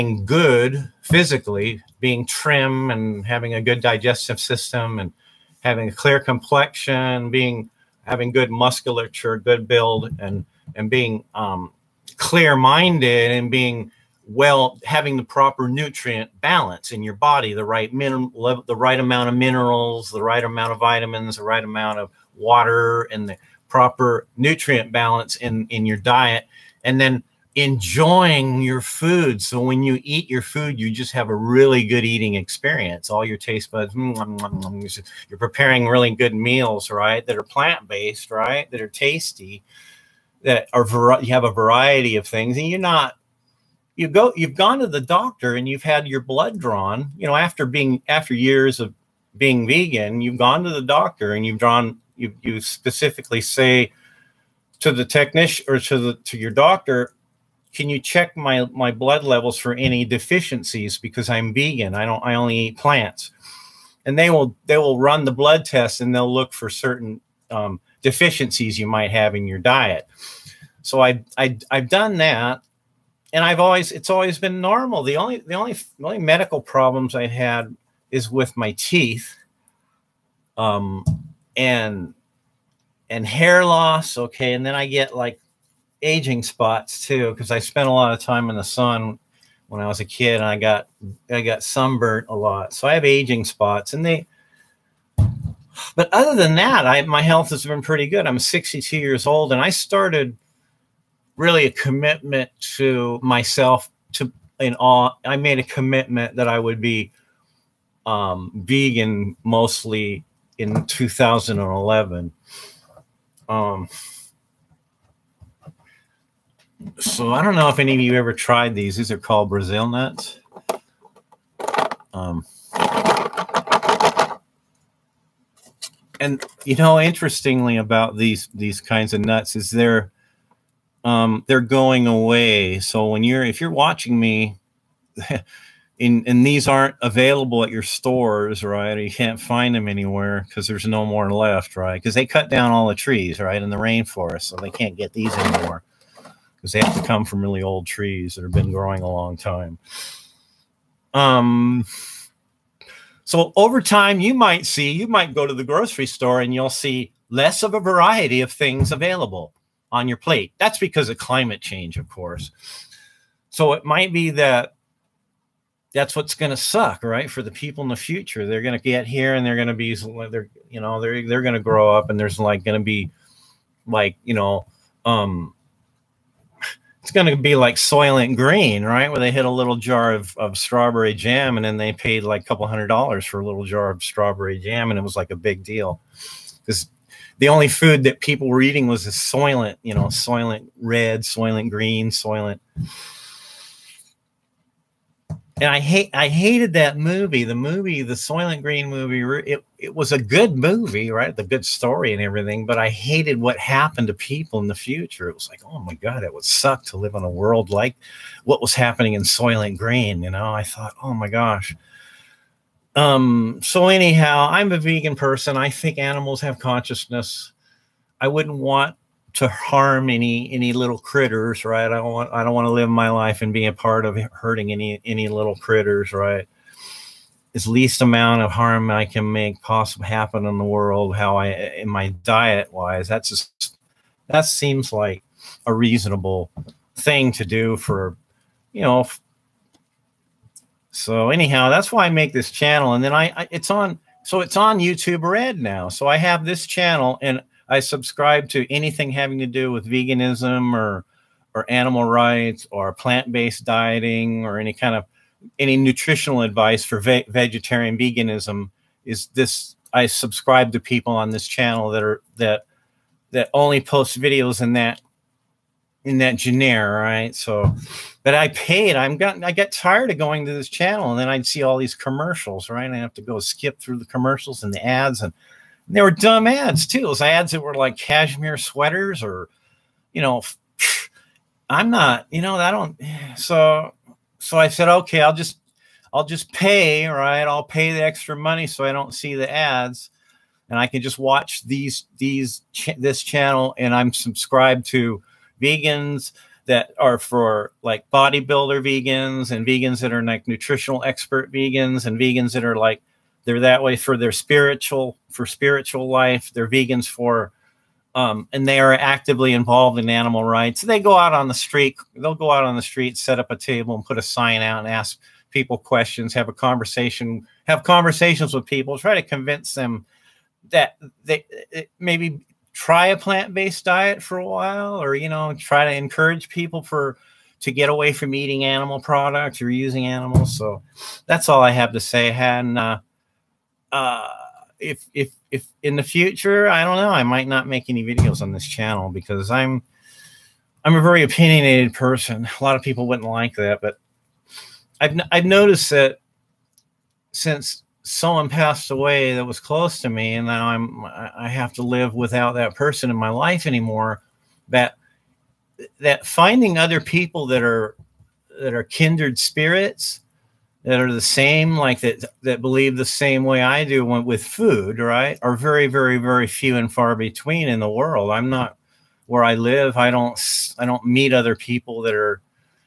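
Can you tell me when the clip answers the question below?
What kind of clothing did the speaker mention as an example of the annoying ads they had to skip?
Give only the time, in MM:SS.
04:37.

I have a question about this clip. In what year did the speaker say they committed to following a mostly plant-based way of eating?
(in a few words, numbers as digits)
2011.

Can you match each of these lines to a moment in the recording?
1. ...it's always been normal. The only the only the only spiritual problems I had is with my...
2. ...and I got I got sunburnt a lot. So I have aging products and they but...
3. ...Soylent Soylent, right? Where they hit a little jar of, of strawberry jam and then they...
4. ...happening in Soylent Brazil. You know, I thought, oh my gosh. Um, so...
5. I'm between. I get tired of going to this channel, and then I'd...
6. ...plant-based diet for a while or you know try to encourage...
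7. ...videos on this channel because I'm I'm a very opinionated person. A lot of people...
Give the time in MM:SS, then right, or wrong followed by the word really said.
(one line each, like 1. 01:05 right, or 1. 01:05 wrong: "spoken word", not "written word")
1. 01:13 wrong: "medical", not "spiritual"
2. 01:30 wrong: "spots", not "products"
3. 02:57 wrong: "Green", not "Soylent"
4. 03:28 wrong: "Green", not "Brazil"
5. 04:28 wrong: "gotten", not "between"
6. 05:23 right
7. 05:38 right.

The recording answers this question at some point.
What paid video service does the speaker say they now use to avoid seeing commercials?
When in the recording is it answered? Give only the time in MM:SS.
04:04.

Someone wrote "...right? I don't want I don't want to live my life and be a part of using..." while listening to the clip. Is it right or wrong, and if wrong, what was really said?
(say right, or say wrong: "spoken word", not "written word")
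wrong: "hurting", not "using".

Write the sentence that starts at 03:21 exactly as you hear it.
The good story and everything, but I hated what happened to people in the future.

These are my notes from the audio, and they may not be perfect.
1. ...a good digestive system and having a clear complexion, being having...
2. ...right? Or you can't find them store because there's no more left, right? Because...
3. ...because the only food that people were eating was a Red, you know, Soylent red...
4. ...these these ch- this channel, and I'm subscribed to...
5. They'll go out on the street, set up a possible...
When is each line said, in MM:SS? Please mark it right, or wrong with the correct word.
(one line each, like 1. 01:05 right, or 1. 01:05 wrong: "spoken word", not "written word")
1. 00:03 right
2. 02:18 wrong: "anywhere", not "store"
3. 03:06 wrong: "Soylent", not "Red"
4. 04:51 right
5. 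05:12 wrong: "table", not "possible".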